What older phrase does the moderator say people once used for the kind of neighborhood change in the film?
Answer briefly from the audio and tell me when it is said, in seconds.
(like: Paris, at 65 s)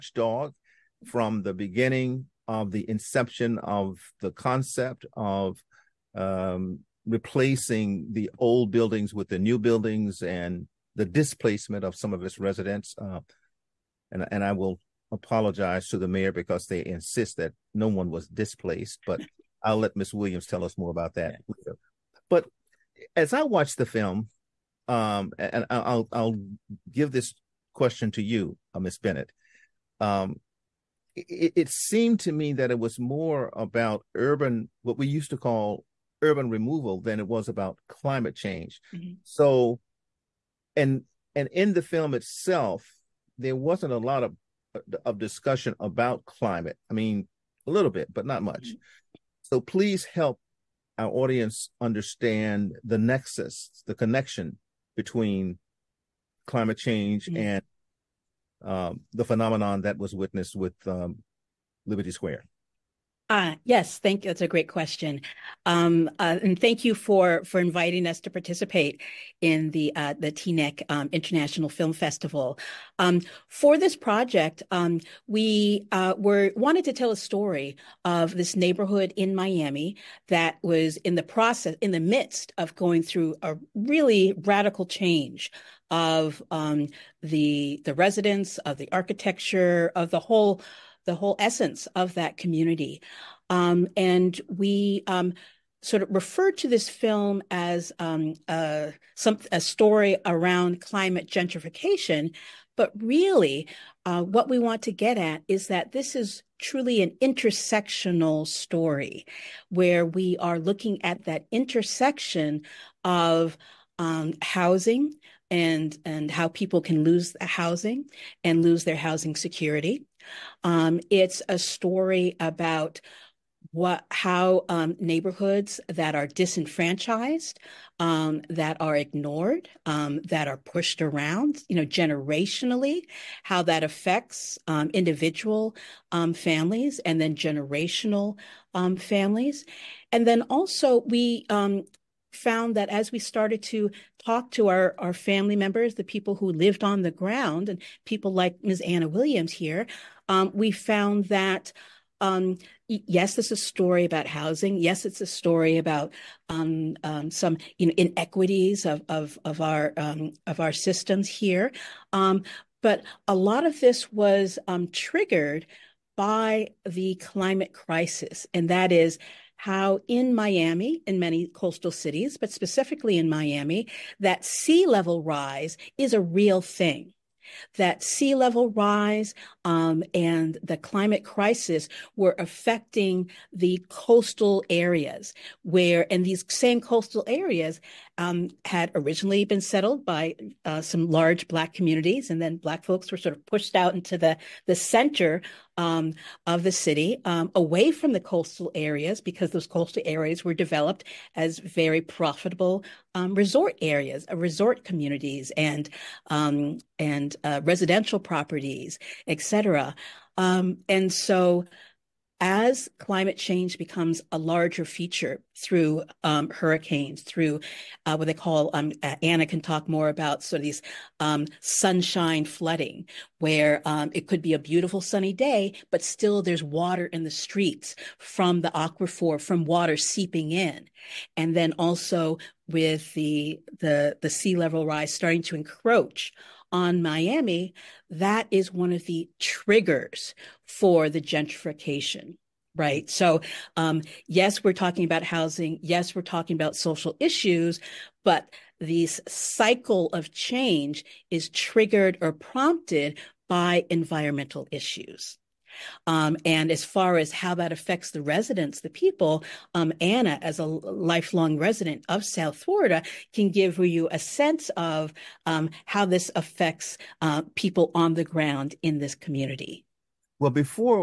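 Urban removal, at 36 s.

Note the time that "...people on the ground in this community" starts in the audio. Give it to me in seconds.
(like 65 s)
267 s.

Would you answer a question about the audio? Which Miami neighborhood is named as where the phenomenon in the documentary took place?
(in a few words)
Liberty Square.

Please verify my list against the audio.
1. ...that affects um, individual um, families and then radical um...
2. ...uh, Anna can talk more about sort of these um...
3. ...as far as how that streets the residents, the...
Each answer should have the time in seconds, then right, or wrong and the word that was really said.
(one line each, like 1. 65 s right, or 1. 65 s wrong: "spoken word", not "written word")
1. 133 s wrong: "generational", not "radical"
2. 219 s right
3. 256 s wrong: "affects", not "streets".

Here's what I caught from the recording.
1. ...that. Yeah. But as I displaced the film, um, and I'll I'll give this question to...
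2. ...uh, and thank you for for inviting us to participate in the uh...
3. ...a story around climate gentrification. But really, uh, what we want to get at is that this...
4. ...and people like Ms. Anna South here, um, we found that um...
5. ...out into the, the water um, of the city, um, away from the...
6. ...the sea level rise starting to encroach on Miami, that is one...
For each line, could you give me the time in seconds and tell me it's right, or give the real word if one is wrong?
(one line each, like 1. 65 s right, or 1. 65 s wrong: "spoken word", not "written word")
1. 21 s wrong: "watched", not "displaced"
2. 66 s right
3. 99 s right
4. 147 s wrong: "Williams", not "South"
5. 193 s wrong: "center", not "water"
6. 234 s right.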